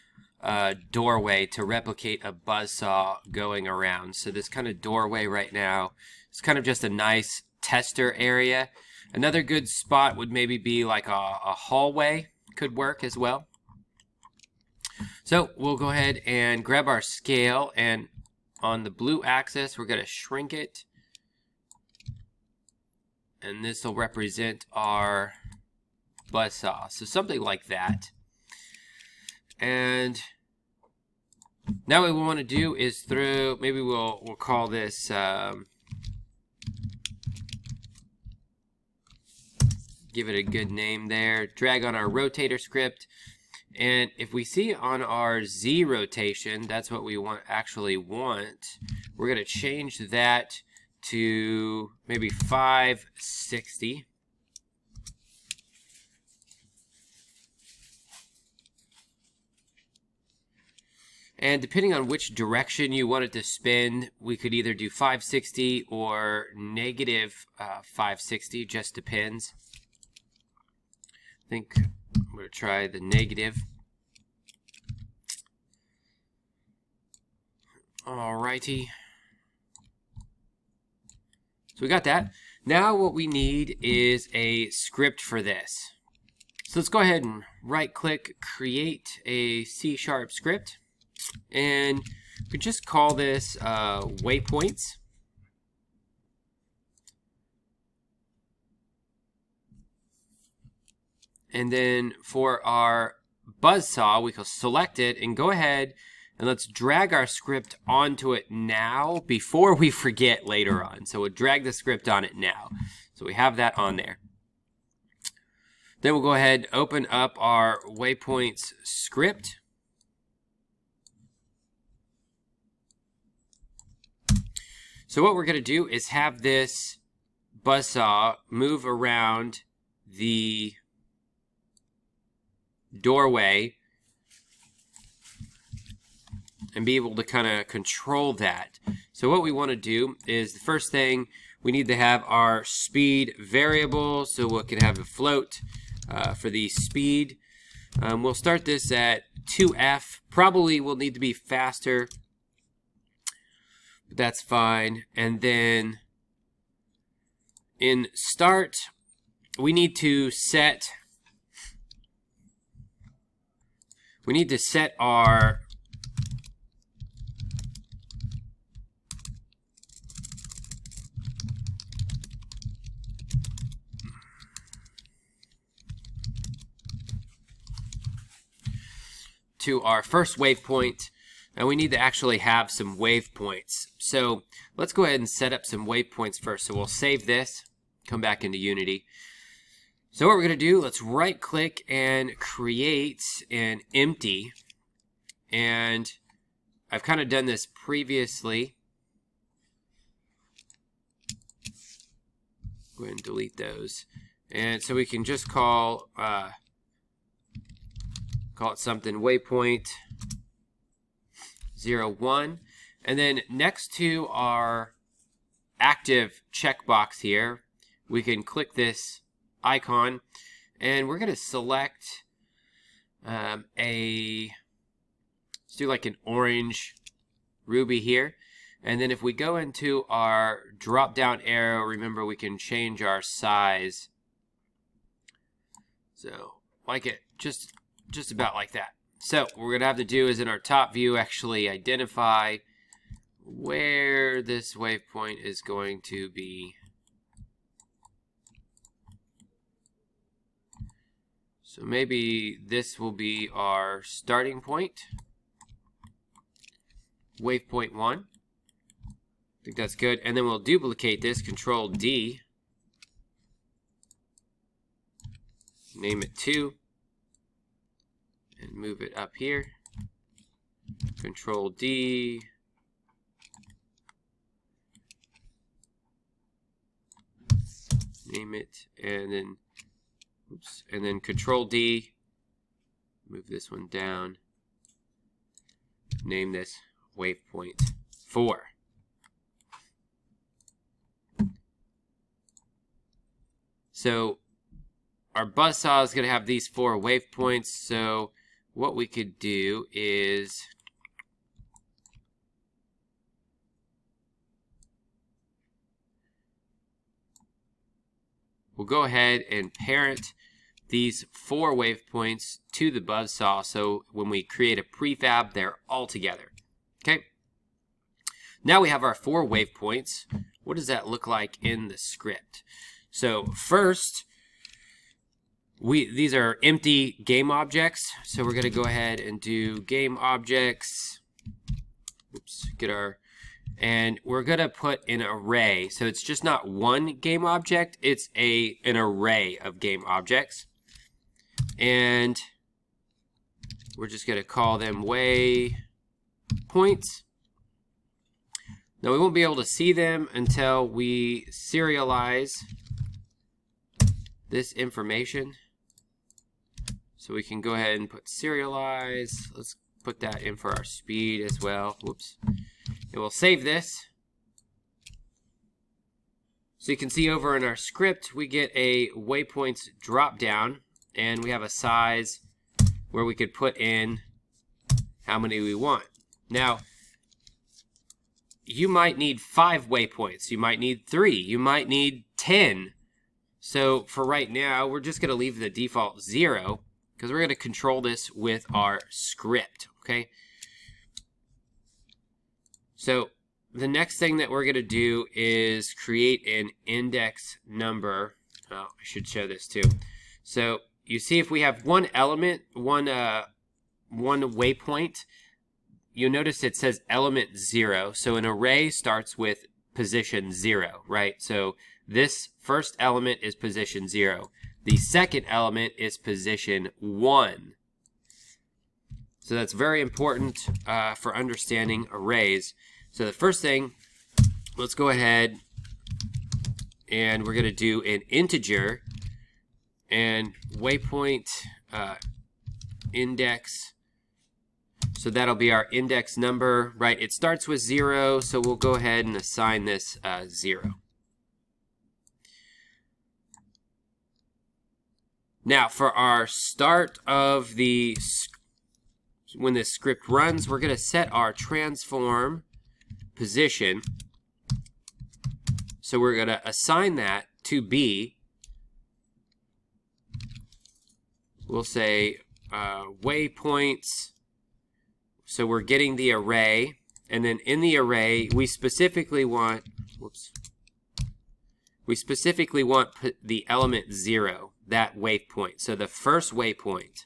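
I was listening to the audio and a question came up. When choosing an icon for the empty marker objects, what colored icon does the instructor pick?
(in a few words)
orange ruby.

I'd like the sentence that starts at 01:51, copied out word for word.
So we'll drag the script on it now.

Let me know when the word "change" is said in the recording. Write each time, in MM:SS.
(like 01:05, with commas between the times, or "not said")
00:49, 03:52.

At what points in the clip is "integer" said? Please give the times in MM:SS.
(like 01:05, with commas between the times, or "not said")
07:08.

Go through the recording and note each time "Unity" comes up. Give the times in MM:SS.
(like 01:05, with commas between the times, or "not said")
03:08.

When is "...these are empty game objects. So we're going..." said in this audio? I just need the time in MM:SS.
05:26.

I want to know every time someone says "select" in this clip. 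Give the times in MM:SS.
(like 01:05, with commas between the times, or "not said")
01:44, 03:41.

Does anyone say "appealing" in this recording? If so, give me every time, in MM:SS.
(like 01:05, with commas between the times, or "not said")
not said.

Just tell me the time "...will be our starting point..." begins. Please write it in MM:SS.
04:13.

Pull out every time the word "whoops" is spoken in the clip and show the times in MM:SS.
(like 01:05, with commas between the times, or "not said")
06:02, 07:50.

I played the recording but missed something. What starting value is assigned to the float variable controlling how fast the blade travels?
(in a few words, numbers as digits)
2f.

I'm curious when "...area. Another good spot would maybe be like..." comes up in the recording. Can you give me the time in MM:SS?
00:08.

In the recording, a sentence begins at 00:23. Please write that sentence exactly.
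And this will represent our saw uh, So something like that.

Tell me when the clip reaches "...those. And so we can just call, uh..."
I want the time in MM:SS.
03:23.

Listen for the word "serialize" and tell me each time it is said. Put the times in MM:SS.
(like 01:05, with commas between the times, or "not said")
05:51, 05:58.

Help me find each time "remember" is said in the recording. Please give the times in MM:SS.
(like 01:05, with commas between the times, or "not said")
03:51.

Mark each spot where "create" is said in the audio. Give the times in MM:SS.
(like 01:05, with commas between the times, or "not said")
01:28, 03:12, 05:14, 06:35.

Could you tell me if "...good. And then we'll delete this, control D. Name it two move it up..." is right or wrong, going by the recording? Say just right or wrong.
wrong.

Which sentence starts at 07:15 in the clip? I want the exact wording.
So that'll be our index number, right?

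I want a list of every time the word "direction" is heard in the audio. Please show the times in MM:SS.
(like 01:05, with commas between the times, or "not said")
01:02.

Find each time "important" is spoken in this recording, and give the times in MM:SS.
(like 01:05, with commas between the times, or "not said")
06:59.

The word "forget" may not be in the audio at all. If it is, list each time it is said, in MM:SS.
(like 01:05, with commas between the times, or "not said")
01:49.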